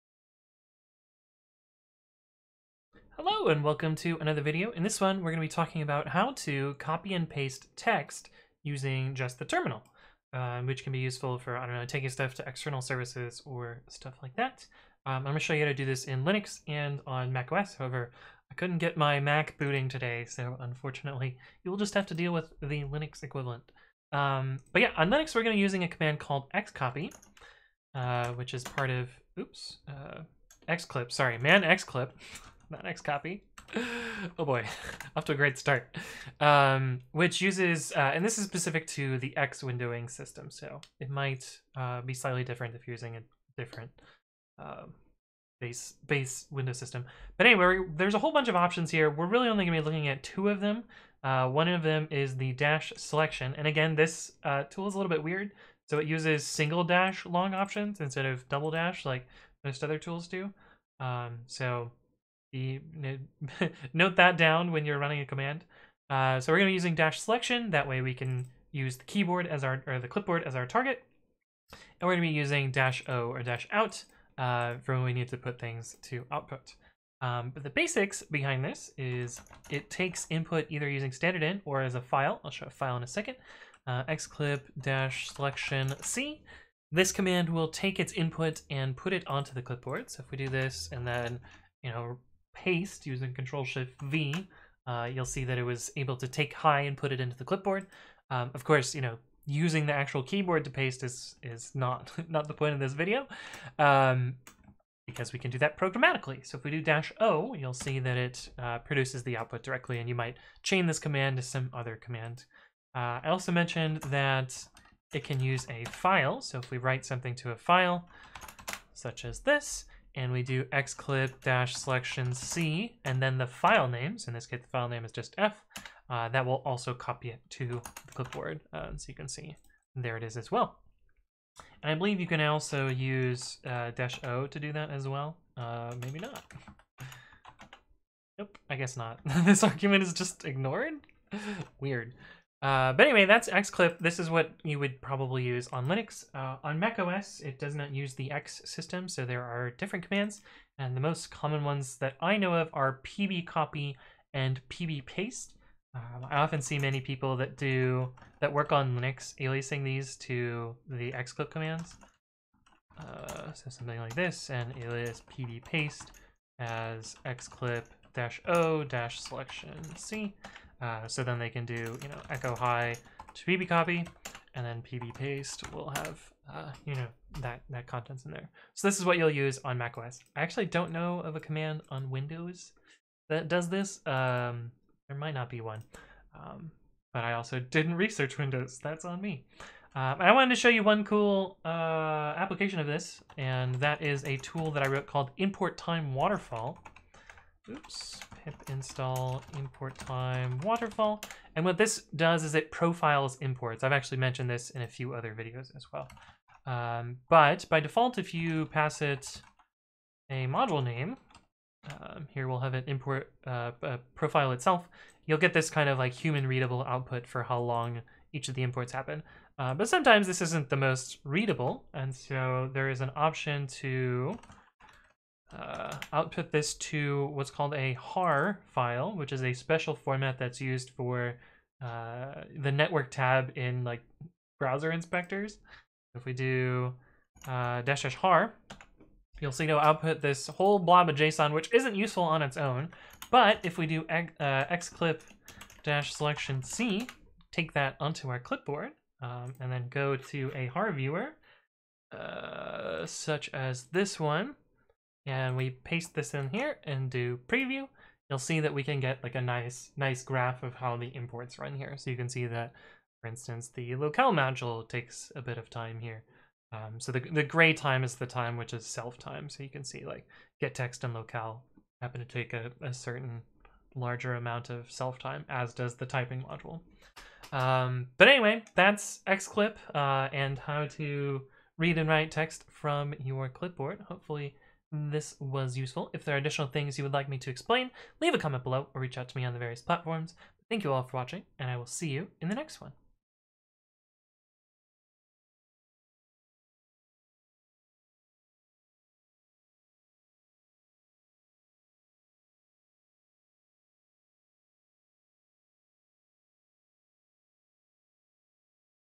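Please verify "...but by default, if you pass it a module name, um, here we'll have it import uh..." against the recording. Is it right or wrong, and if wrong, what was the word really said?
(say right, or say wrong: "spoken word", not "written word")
right.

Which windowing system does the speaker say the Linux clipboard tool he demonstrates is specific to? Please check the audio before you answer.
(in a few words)
X windowing system.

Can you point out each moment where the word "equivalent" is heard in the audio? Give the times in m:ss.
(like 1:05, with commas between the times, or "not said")
0:23.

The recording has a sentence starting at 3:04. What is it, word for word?
Um, there might not be one, um, but I also didn't research Windows.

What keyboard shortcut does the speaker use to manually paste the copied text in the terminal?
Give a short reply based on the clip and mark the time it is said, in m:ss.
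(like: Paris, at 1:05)
Control Shift V, at 1:33.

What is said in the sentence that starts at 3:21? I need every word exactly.
And what this does is it profiles imports.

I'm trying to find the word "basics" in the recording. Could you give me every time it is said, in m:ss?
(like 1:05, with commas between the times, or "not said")
1:17.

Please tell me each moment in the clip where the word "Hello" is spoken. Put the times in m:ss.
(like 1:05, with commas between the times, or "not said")
0:03.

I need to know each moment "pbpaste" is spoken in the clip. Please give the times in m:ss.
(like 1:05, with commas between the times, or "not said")
2:34, 2:45.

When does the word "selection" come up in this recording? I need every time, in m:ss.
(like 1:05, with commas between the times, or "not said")
0:52, 1:07, 1:25, 2:01, 2:47, 4:06.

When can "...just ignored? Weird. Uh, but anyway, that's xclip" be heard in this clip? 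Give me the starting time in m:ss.
2:20.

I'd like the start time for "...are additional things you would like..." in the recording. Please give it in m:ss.
4:46.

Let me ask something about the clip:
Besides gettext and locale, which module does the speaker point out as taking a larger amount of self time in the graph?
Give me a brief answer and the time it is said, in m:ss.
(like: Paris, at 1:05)
typing, at 4:36.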